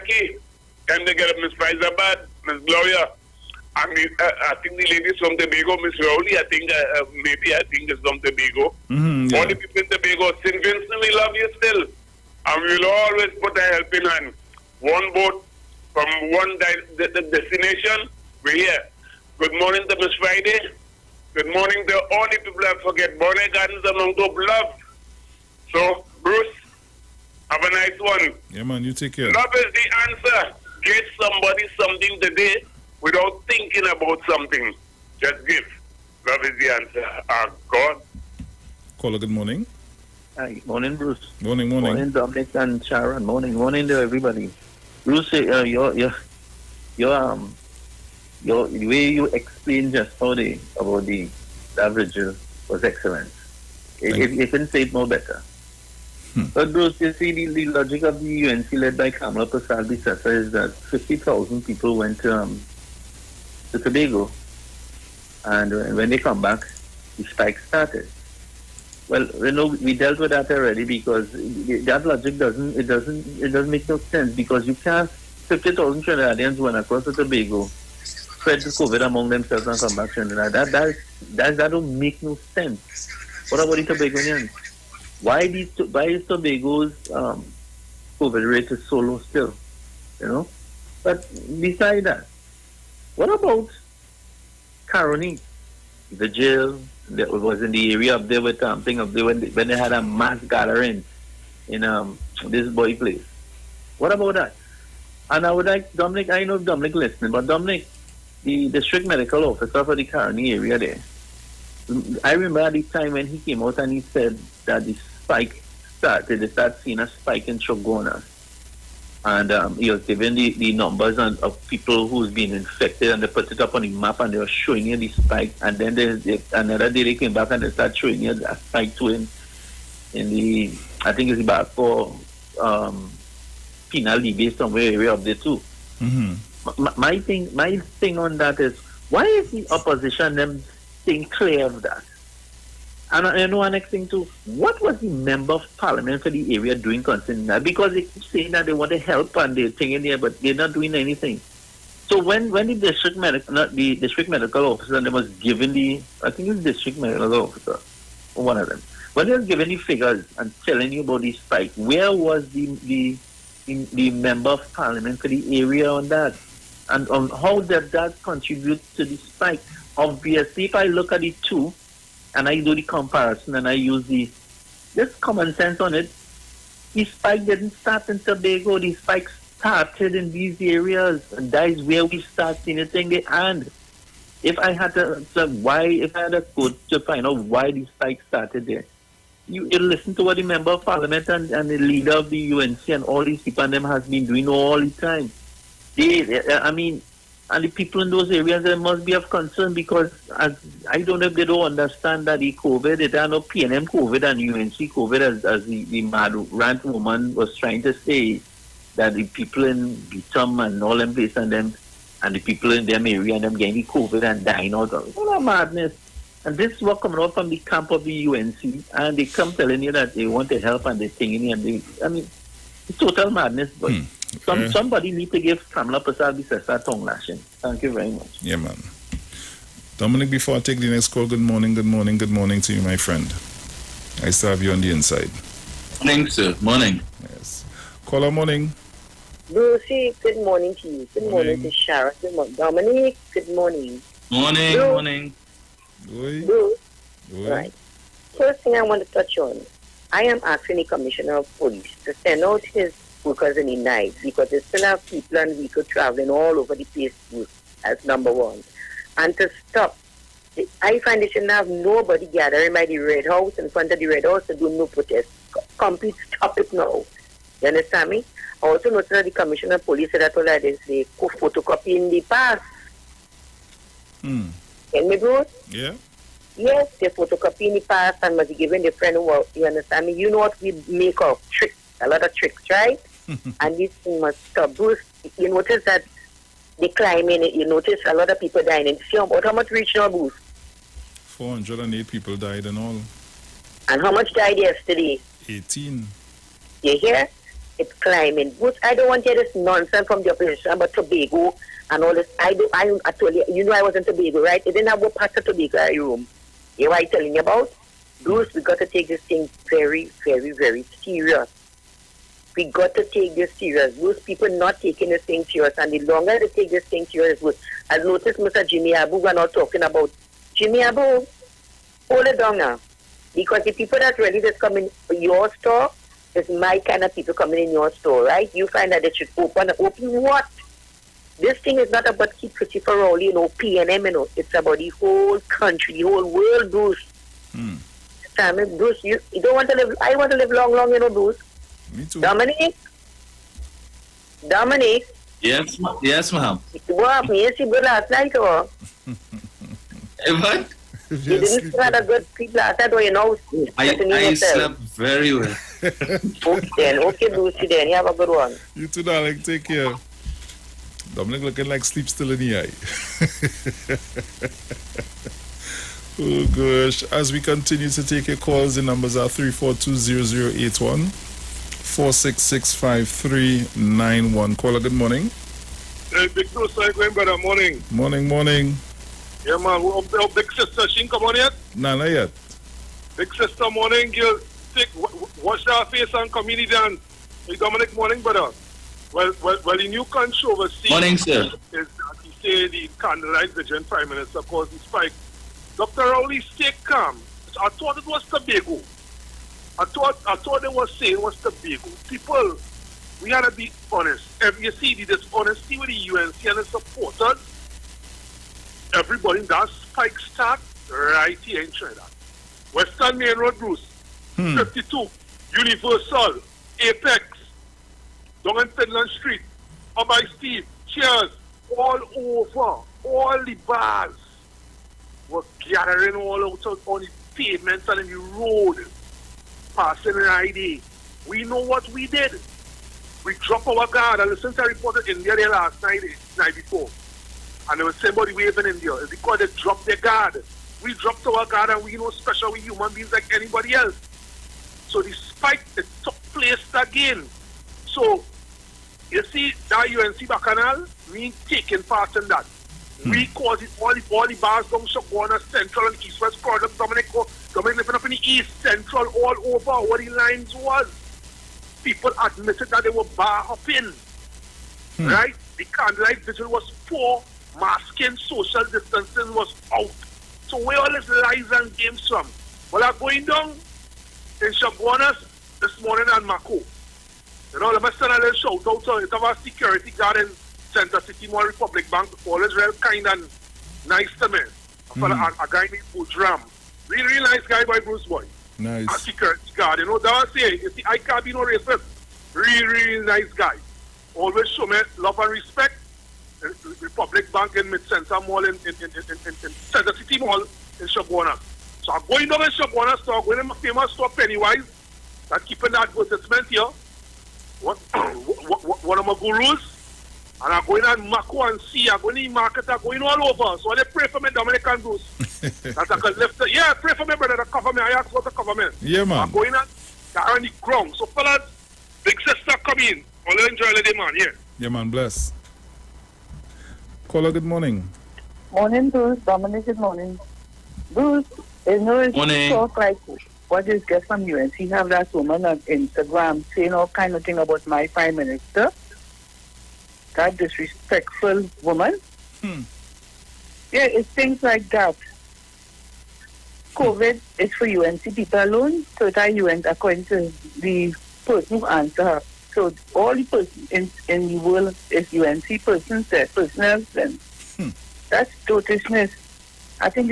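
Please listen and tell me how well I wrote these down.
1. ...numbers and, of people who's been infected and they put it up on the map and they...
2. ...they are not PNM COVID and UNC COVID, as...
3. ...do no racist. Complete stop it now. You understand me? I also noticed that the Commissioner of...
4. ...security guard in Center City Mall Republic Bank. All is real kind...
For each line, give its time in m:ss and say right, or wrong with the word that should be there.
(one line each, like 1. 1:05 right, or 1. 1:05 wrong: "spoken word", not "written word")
1. 2:00 right
2. 3:23 right
3. 4:24 wrong: "protest", not "racist"
4. 7:59 right.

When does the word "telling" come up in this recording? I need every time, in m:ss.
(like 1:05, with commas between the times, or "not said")
2:40, 3:39, 5:07.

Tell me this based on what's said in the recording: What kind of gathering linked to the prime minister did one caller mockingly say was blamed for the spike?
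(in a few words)
candlelight vigil.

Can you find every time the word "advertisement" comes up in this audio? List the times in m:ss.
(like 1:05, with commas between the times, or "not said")
8:25.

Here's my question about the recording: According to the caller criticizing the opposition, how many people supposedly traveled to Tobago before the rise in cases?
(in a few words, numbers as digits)
50,000.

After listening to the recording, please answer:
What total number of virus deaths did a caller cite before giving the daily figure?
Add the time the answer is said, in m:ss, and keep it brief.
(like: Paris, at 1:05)
408, at 4:51.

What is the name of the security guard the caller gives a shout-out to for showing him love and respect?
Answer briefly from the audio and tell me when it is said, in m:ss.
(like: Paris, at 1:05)
Budram, at 8:05.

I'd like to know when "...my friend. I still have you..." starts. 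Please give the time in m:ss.
3:52.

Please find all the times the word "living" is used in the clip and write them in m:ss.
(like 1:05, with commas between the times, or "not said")
7:37.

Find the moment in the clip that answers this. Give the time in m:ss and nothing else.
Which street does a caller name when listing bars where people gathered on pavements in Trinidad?
6:58.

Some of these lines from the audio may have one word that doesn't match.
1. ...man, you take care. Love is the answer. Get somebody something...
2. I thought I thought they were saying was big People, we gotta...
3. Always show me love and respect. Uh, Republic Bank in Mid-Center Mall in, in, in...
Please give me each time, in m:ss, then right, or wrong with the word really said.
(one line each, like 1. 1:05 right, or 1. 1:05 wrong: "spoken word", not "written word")
1. 0:28 right
2. 6:39 right
3. 8:14 right.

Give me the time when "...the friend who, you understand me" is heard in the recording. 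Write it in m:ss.
4:38.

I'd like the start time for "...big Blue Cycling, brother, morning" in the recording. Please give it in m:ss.
6:16.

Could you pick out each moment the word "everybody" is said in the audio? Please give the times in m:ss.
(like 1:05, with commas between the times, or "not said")
0:44, 6:48.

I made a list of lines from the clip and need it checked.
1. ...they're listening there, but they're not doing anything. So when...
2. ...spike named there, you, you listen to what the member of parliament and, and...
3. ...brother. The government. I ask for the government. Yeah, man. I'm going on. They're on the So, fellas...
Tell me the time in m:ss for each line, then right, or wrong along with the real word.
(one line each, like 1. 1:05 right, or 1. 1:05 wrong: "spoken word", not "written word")
1. 2:29 wrong: "thinking", not "listening"
2. 3:07 wrong: "started", not "named"
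3. 8:37 right.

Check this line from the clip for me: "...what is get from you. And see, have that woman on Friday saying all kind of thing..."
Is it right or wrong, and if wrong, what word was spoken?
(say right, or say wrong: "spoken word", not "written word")
wrong: "Instagram", not "Friday".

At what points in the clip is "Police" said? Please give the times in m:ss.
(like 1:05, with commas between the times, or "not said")
4:11, 4:29.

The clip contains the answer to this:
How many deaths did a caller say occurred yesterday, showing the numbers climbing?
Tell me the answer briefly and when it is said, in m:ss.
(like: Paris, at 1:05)
18, at 4:55.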